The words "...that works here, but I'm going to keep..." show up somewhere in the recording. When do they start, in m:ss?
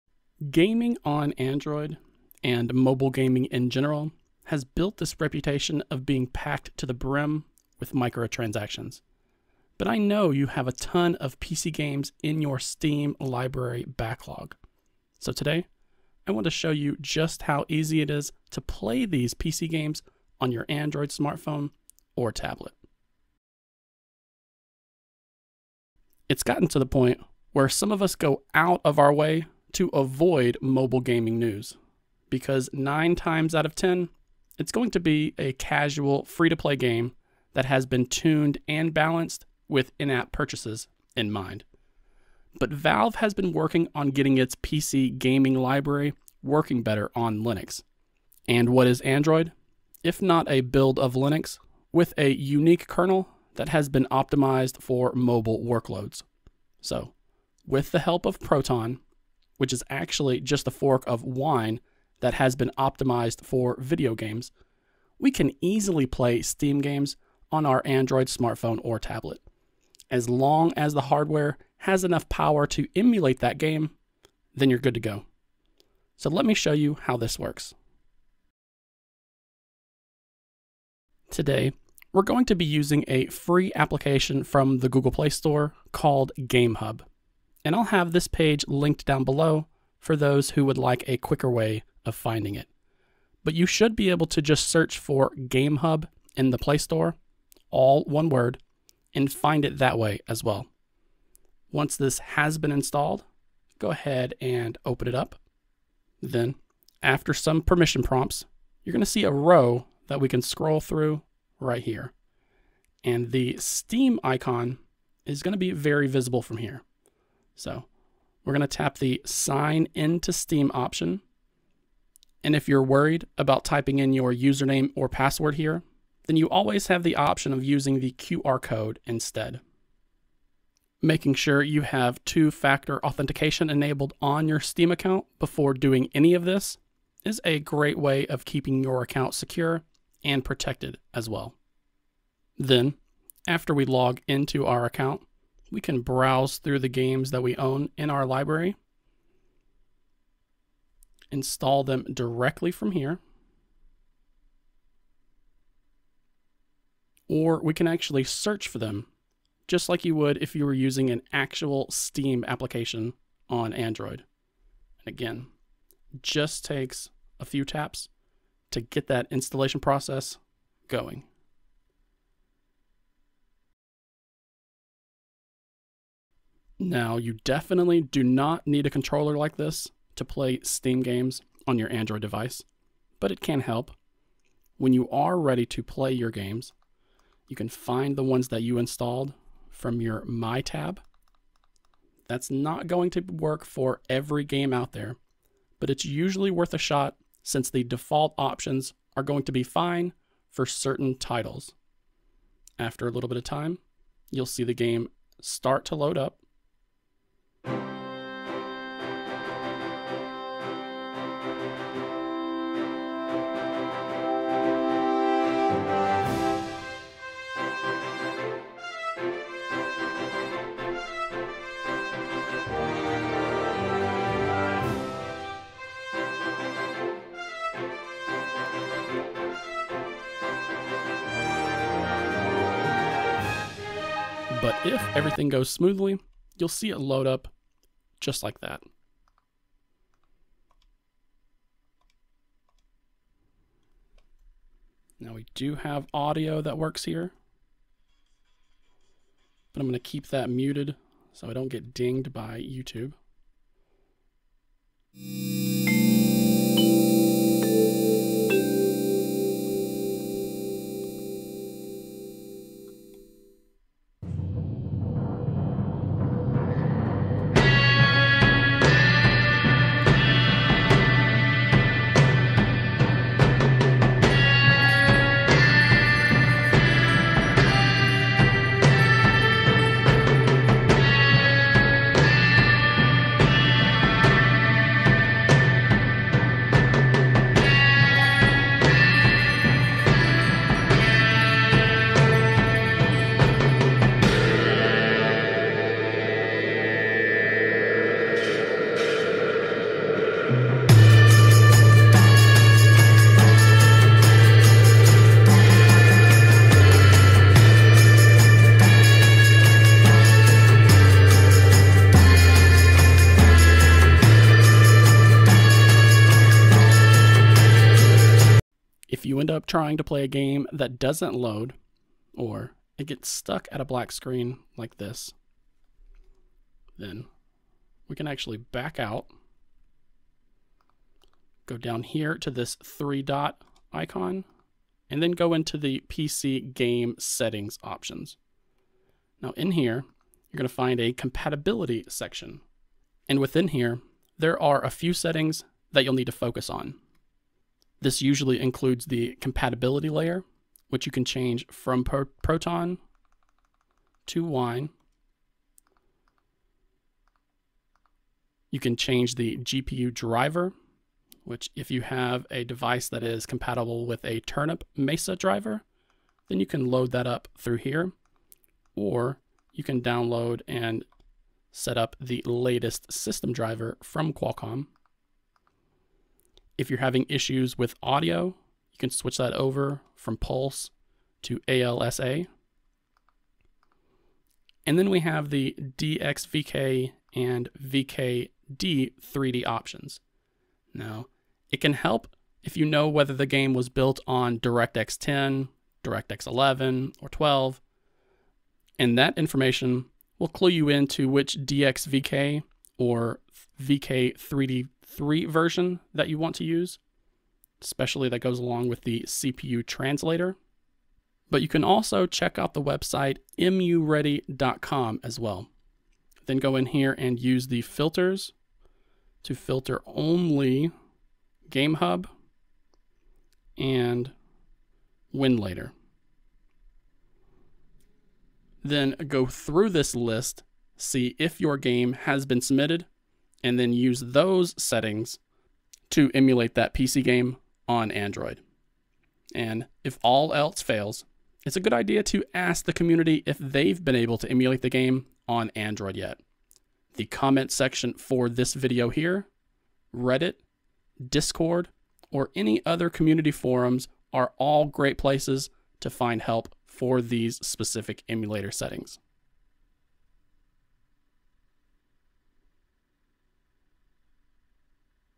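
4:06.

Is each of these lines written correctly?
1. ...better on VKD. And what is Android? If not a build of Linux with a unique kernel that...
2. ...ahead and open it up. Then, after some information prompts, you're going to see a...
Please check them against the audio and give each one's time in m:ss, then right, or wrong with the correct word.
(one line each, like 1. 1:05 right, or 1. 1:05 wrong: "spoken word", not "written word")
1. 0:46 wrong: "Linux", not "VKD"
2. 1:43 wrong: "permission", not "information".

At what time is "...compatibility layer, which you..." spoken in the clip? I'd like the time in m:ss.
5:49.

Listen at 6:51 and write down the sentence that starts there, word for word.
But you can also check out the website emuready.com as well.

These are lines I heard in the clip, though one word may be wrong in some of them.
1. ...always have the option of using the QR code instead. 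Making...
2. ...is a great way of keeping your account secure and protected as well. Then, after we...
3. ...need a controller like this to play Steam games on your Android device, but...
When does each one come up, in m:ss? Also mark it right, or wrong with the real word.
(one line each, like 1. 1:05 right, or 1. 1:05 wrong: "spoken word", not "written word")
1. 2:06 right
2. 2:17 right
3. 2:58 right.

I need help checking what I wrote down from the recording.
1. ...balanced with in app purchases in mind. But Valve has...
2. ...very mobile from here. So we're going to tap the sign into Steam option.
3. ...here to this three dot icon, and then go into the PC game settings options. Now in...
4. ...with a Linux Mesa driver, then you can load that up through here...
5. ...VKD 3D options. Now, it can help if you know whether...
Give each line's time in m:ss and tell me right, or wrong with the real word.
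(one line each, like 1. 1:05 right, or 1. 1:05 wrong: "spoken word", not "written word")
1. 0:38 right
2. 1:55 wrong: "visible", not "mobile"
3. 5:32 right
4. 6:04 wrong: "Turnip", not "Linux"
5. 6:27 right.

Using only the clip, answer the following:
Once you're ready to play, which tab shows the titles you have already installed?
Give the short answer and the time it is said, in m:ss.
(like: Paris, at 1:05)
My tab, at 3:10.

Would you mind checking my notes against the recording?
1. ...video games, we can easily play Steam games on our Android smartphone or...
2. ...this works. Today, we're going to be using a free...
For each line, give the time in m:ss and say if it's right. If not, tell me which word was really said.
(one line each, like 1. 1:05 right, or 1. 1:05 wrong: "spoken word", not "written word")
1. 1:03 right
2. 1:17 right.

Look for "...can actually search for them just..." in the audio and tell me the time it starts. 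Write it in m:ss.
2:37.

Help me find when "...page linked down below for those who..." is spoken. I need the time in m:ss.
1:28.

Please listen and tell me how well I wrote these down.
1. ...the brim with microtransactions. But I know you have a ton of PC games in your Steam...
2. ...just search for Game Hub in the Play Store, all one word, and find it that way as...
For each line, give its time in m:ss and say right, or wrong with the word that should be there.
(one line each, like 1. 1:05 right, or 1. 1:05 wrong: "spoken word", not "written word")
1. 0:06 right
2. 1:34 right.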